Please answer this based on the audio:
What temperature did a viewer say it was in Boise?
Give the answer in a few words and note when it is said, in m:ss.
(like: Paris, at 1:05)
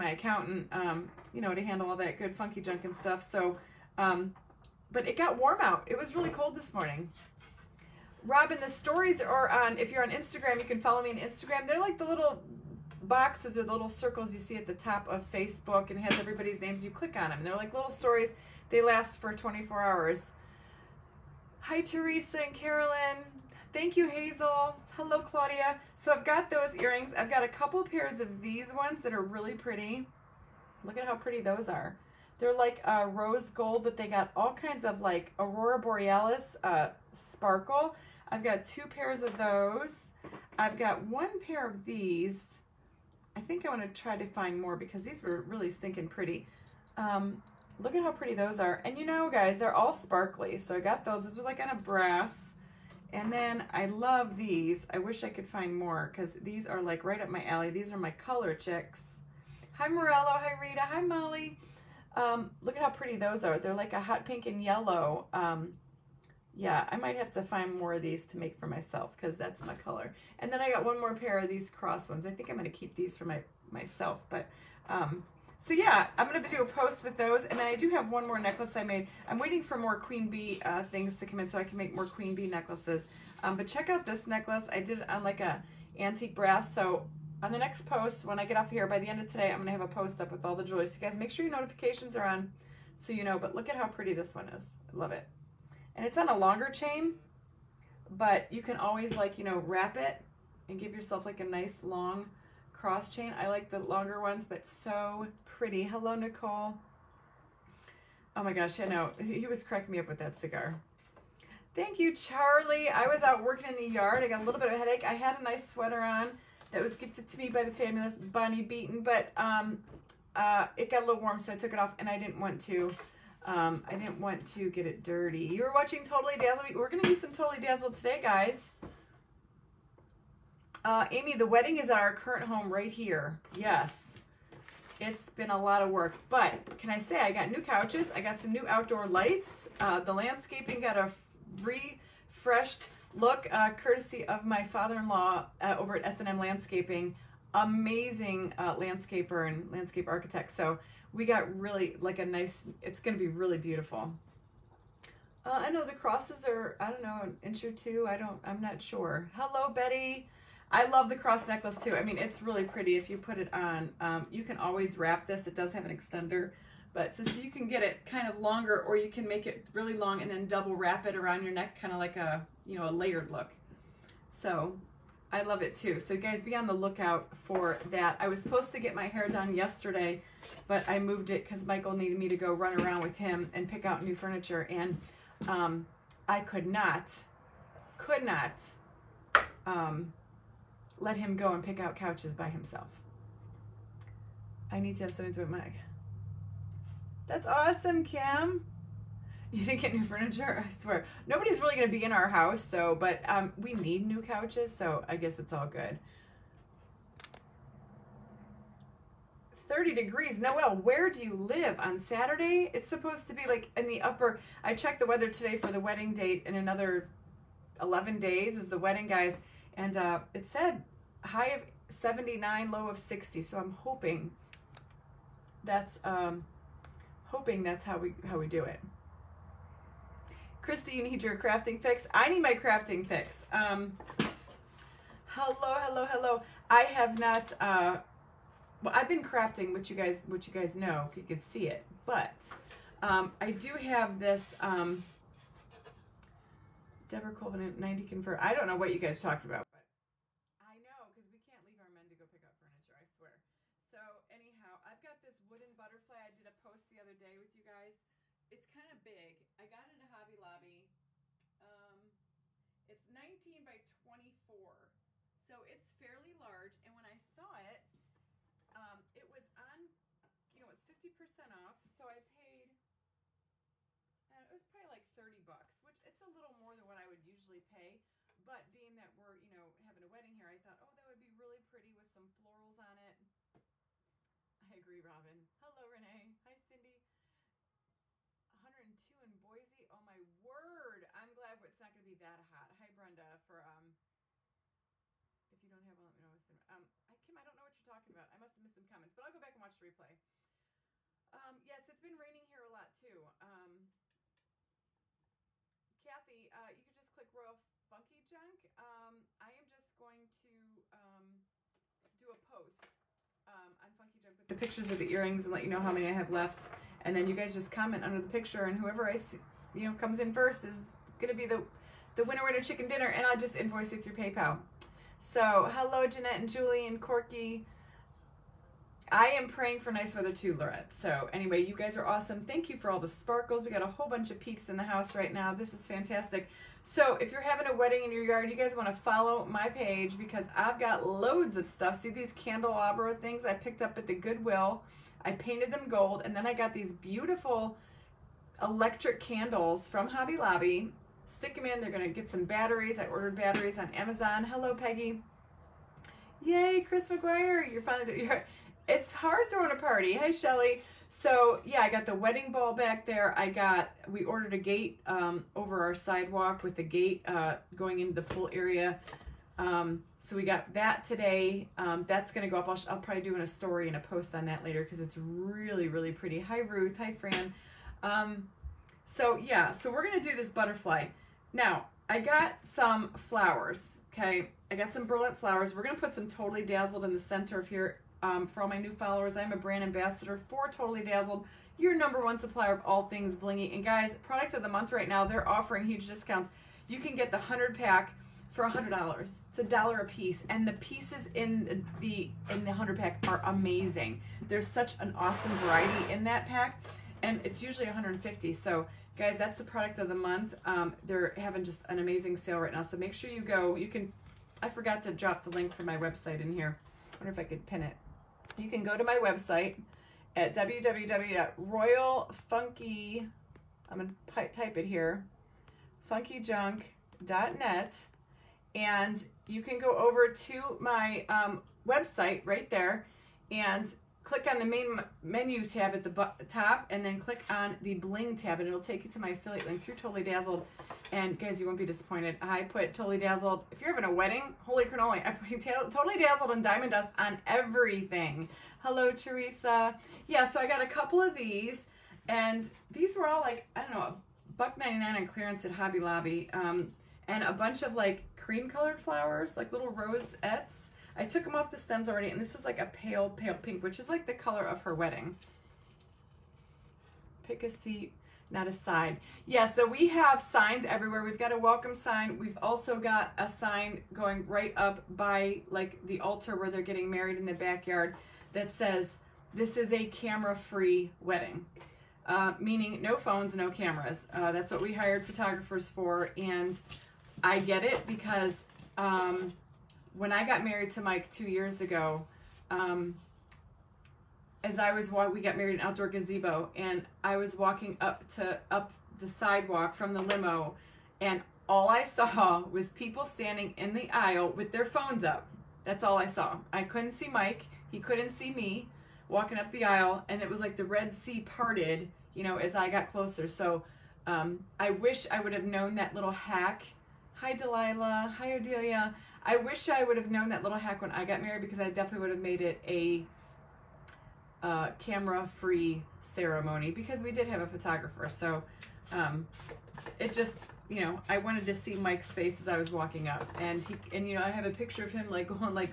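102, at 4:48.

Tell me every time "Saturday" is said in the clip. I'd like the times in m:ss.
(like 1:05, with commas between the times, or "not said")
3:31.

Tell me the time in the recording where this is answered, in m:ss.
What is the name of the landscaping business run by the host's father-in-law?
2:26.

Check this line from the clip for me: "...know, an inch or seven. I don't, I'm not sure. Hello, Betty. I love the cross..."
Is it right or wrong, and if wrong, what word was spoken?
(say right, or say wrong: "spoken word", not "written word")
wrong: "two", not "seven".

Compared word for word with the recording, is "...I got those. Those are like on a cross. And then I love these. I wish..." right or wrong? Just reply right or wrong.
wrong.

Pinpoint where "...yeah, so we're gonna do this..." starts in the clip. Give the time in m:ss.
6:19.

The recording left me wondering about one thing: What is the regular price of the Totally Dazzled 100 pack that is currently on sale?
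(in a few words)
$150.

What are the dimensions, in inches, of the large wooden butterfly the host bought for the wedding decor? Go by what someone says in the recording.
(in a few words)
19 by 24.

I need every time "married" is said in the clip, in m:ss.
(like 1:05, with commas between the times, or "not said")
7:57, 8:10, 8:15, 8:41.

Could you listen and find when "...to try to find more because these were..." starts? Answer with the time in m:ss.
0:43.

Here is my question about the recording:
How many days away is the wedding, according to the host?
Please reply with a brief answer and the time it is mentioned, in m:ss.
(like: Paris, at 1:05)
11, at 3:37.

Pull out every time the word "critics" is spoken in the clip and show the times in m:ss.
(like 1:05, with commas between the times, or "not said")
not said.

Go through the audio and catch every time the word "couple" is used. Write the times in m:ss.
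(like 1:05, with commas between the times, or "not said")
0:27, 7:30.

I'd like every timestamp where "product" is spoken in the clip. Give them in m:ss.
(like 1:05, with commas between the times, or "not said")
6:34, 6:49.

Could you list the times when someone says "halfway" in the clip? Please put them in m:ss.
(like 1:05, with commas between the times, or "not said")
not said.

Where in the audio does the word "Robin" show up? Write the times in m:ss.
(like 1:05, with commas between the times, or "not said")
0:08, 4:45.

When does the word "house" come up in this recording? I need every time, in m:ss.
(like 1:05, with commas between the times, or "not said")
3:22, 5:34.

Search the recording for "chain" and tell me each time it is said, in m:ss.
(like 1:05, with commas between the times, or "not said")
1:36, 1:43.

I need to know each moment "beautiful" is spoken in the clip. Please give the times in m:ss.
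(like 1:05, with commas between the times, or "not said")
2:33, 5:46.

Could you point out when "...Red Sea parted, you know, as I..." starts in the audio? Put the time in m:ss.
8:30.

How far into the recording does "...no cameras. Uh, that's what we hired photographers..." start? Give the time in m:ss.
8:03.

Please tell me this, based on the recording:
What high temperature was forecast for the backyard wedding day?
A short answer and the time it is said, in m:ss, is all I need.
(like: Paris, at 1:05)
79, at 3:41.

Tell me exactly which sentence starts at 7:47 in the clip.
Pick a seat, not a side.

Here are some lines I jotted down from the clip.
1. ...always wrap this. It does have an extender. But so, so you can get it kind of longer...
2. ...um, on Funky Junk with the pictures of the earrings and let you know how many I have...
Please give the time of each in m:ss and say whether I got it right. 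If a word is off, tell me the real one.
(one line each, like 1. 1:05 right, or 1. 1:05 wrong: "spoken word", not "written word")
1. 2:44 right
2. 5:13 right.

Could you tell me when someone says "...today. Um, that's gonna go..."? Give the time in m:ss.
6:11.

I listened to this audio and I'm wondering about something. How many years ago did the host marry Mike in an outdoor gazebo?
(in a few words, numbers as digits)
2.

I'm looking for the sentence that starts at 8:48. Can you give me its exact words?
So um, it just, you know, I wanted to see Mike's face as I was walking up.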